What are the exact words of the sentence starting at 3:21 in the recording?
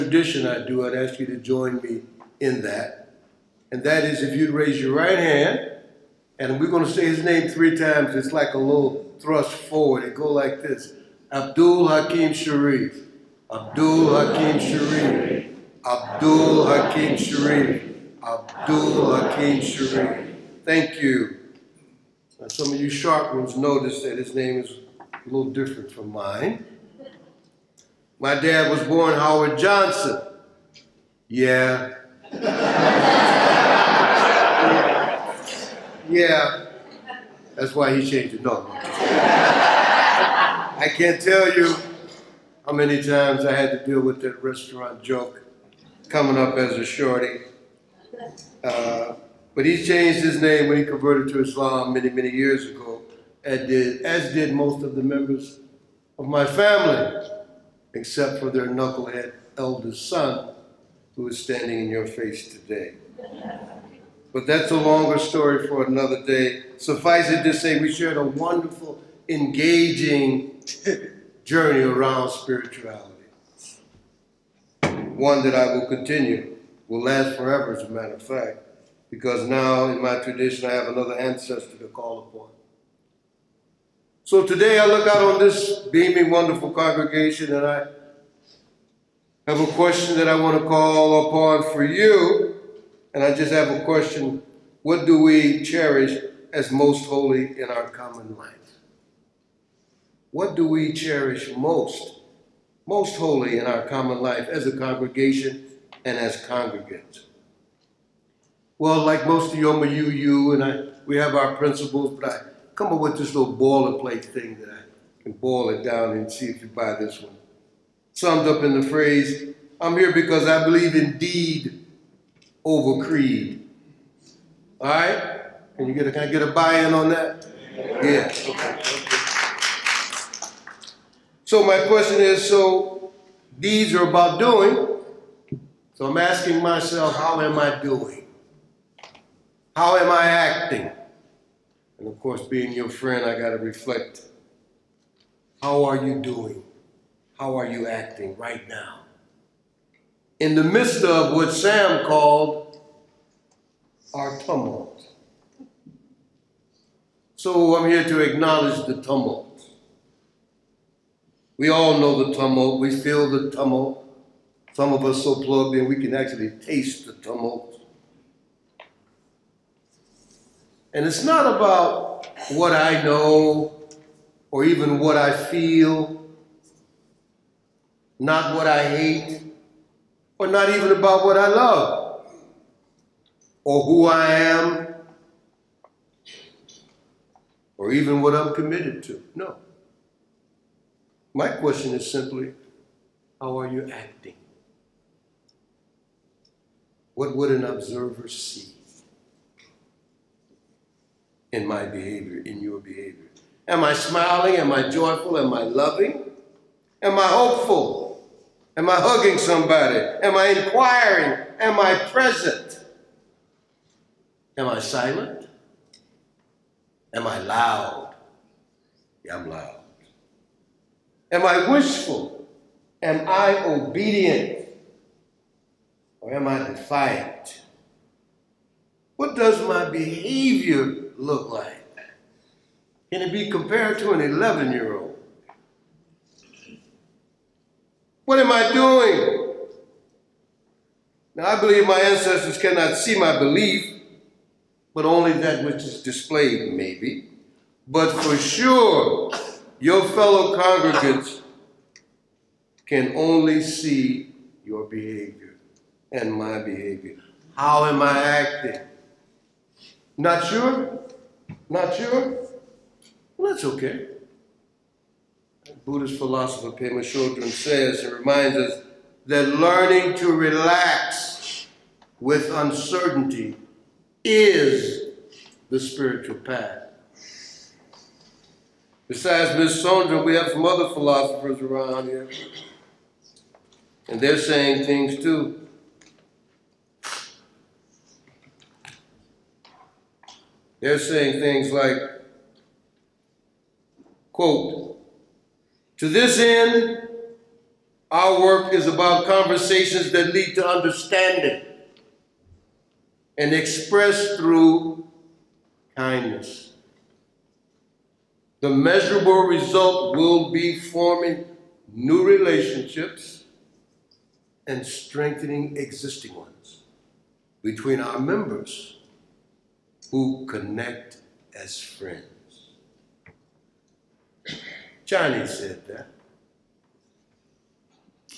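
in my behavior, in your behavior?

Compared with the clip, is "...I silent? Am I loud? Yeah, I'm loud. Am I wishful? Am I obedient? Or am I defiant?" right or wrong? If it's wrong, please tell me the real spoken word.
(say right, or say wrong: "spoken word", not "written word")
right.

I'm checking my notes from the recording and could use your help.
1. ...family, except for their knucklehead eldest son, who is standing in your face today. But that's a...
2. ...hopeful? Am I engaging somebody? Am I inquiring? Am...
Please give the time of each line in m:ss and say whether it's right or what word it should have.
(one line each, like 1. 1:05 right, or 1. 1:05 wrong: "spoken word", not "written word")
1. 0:56 right
2. 3:27 wrong: "hugging", not "engaging".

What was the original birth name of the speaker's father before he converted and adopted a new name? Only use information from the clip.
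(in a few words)
Howard Johnson.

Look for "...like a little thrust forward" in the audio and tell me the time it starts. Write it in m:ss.
0:08.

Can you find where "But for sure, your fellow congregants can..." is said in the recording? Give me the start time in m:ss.
4:07.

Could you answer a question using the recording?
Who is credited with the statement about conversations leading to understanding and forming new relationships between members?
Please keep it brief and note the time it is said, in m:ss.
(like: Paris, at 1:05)
Johnny, at 5:25.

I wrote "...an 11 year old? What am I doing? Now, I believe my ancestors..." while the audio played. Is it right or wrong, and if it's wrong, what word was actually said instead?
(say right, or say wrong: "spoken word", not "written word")
right.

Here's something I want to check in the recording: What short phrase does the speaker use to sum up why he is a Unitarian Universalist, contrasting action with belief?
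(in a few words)
deed over creed.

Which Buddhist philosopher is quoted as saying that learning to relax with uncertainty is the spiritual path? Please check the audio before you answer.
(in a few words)
Pema Chodron.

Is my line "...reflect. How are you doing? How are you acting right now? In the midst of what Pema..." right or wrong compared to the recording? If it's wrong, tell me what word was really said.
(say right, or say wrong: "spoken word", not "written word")
wrong: "Sam", not "Pema".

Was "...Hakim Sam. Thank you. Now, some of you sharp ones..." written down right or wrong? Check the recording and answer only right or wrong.
wrong.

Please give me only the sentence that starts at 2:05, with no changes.
Can you get a, can I get a buy-in on that?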